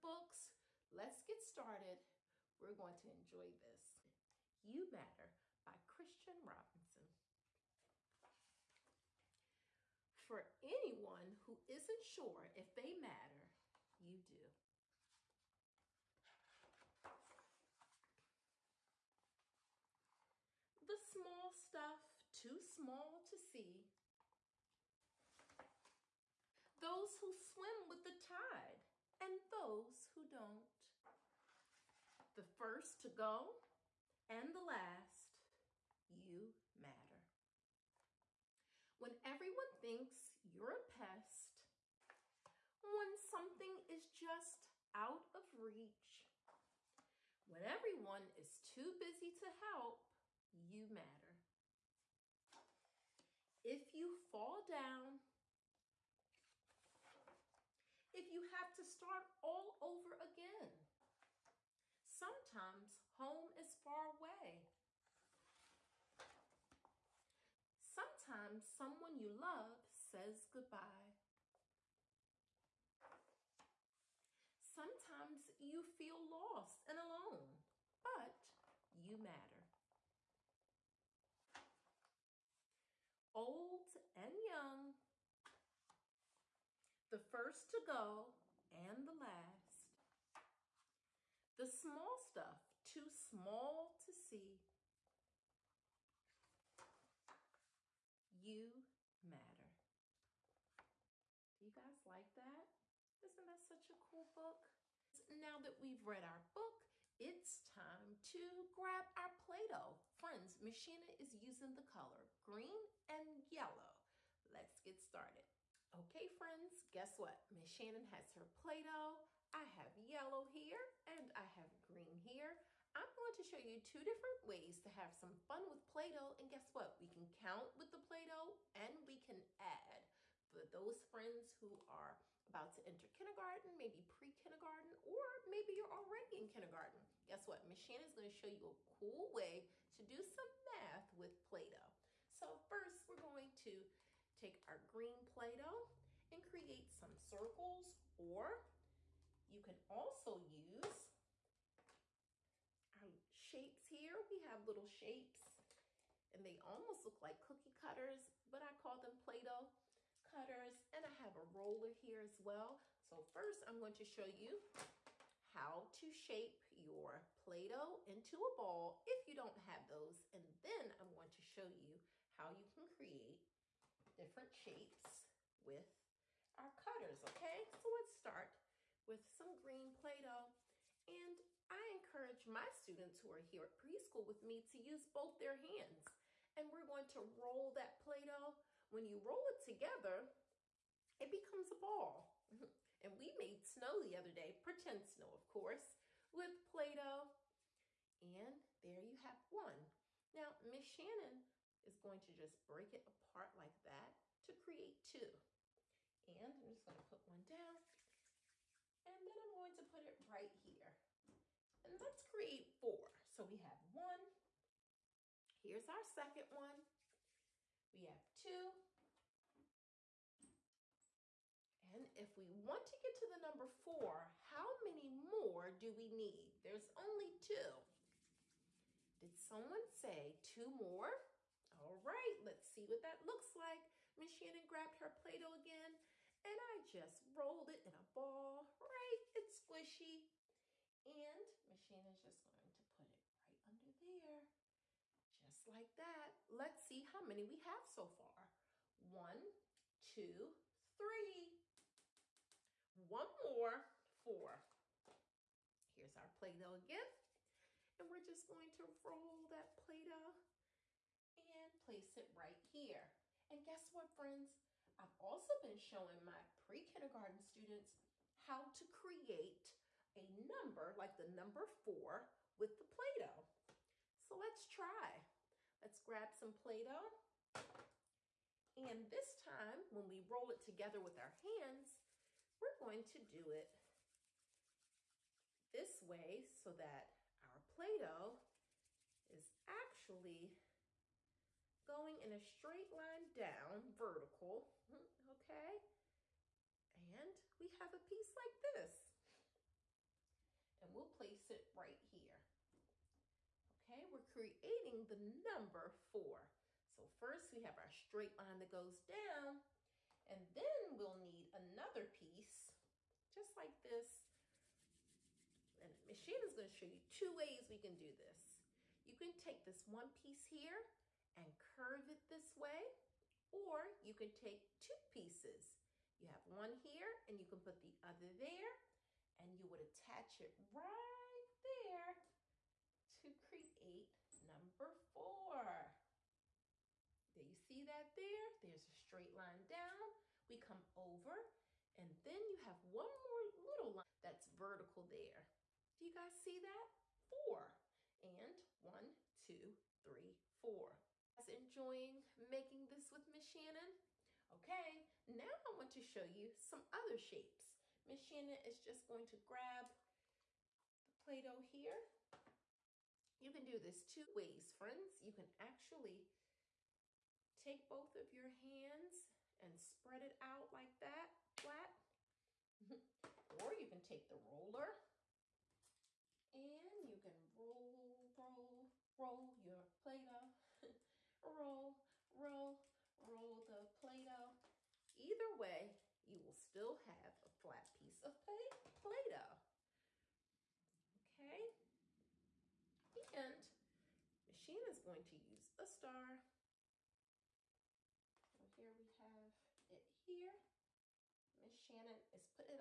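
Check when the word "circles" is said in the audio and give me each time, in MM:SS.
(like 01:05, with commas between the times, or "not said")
02:27.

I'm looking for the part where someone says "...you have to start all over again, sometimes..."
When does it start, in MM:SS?
00:58.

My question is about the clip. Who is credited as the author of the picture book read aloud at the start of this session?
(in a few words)
Christian Robinson.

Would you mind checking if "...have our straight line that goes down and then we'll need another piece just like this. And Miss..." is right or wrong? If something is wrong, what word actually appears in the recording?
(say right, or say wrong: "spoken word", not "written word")
right.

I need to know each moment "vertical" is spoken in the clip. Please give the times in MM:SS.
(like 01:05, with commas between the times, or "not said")
04:53, 05:44.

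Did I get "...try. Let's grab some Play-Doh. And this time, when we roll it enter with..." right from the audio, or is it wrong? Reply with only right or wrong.
wrong.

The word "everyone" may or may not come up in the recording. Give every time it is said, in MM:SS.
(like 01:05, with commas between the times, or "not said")
00:39, 00:47.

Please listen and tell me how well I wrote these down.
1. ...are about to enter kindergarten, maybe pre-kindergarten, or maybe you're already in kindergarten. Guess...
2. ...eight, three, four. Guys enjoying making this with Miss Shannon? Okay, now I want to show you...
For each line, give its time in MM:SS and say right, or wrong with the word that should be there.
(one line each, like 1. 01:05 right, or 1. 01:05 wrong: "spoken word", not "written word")
1. 02:11 right
2. 05:49 wrong: "two", not "eight".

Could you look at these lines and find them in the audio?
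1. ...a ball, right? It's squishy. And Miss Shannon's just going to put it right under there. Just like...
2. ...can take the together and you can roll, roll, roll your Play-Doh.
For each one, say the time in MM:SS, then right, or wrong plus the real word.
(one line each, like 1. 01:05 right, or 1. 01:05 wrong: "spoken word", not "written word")
1. 03:57 right
2. 06:13 wrong: "roller", not "together".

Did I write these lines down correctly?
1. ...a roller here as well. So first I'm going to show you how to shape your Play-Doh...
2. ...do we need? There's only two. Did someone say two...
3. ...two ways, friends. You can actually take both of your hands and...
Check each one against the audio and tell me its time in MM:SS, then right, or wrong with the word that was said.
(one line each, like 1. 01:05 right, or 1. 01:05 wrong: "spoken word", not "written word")
1. 02:41 right
2. 03:45 right
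3. 06:04 right.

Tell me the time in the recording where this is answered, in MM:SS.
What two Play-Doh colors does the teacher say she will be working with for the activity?
01:52.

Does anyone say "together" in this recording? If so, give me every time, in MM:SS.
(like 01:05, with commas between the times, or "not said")
03:09, 04:40.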